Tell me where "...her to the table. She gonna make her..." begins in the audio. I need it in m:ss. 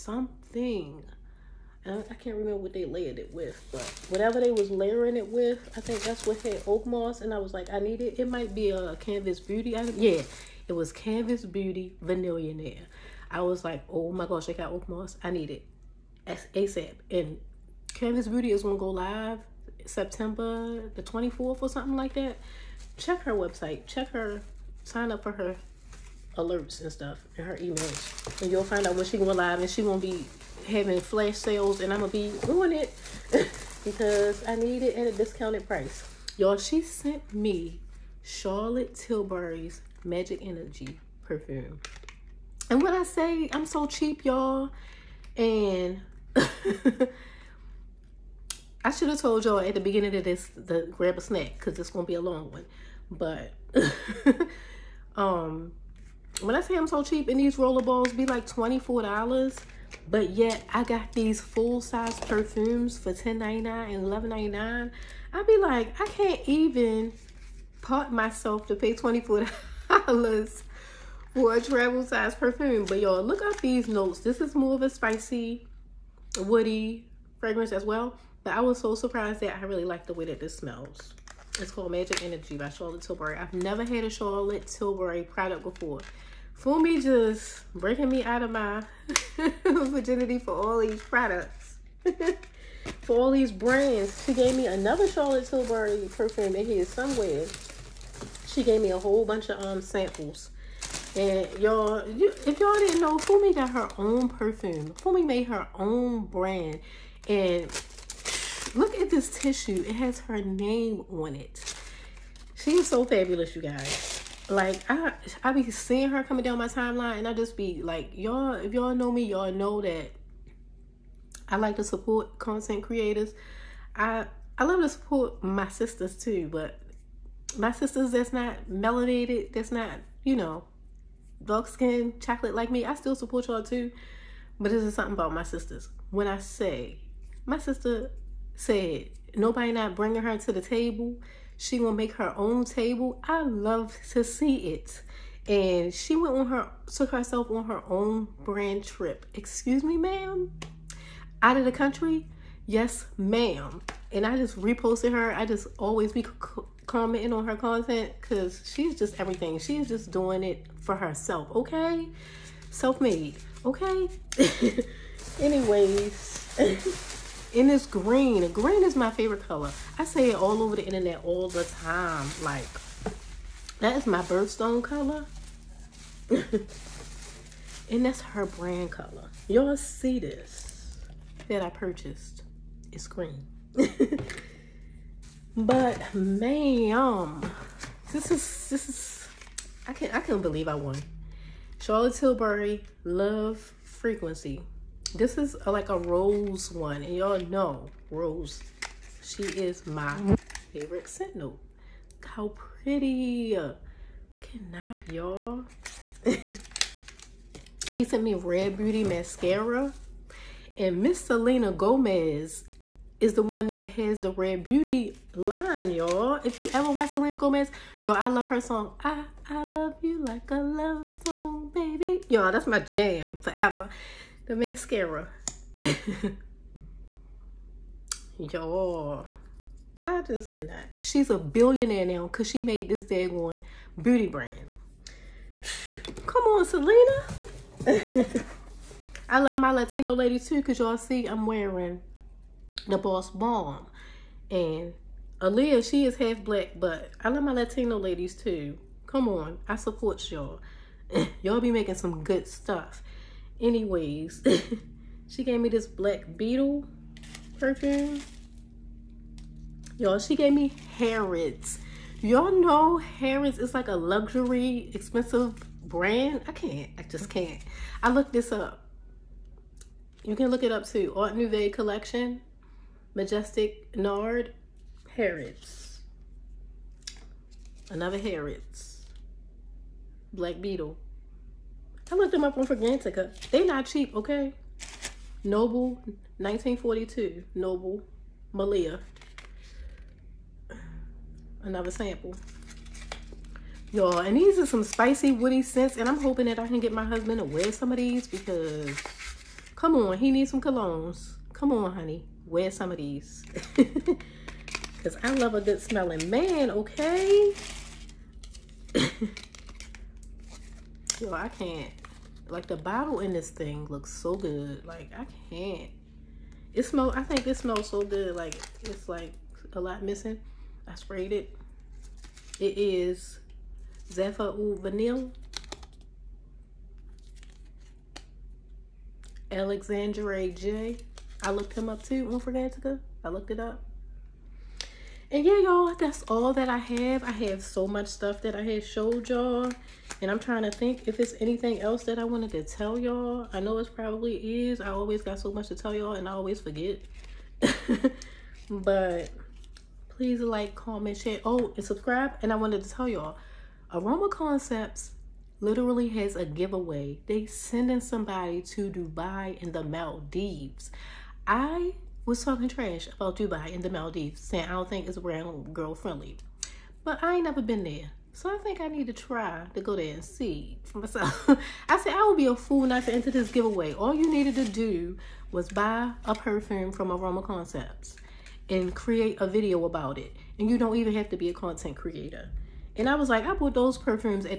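2:20.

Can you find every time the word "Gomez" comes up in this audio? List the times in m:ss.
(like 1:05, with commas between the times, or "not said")
3:31, 3:37.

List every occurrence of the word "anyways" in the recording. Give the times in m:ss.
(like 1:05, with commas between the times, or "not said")
2:45, 4:13.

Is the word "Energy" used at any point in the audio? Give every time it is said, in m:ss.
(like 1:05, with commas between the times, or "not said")
0:40, 1:22.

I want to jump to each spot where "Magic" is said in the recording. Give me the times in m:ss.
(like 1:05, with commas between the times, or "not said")
0:40, 1:21.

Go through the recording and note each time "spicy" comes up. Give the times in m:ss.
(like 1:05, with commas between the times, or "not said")
1:14, 4:54.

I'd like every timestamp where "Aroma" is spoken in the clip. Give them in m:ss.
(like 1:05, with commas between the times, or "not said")
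5:53, 6:17.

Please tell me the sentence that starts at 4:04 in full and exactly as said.
And Aaliyah, she is half black, but I love my Latino ladies too.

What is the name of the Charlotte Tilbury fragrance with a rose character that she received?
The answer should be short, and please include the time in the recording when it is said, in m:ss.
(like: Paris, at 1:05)
Love Frequency, at 3:13.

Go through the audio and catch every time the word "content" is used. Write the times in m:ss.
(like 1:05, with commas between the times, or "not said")
2:02, 2:37, 6:21.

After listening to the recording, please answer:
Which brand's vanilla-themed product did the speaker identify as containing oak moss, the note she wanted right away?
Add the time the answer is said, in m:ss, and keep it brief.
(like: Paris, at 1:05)
Canvas Beauty Vanillionaire, at 0:10.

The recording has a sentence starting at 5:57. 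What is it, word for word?
They sending somebody to Dubai and the Maldives.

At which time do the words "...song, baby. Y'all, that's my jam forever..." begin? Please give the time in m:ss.
3:41.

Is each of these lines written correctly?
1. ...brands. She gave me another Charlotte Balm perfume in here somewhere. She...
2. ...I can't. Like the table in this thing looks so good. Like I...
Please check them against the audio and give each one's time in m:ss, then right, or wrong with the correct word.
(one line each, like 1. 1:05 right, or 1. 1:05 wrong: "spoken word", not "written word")
1. 1:33 wrong: "Tilbury", not "Balm"
2. 5:11 wrong: "bottle", not "table".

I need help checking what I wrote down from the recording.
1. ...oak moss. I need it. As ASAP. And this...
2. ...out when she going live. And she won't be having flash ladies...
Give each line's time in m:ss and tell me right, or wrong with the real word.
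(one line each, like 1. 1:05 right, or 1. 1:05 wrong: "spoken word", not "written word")
1. 0:14 right
2. 0:28 wrong: "sales", not "ladies".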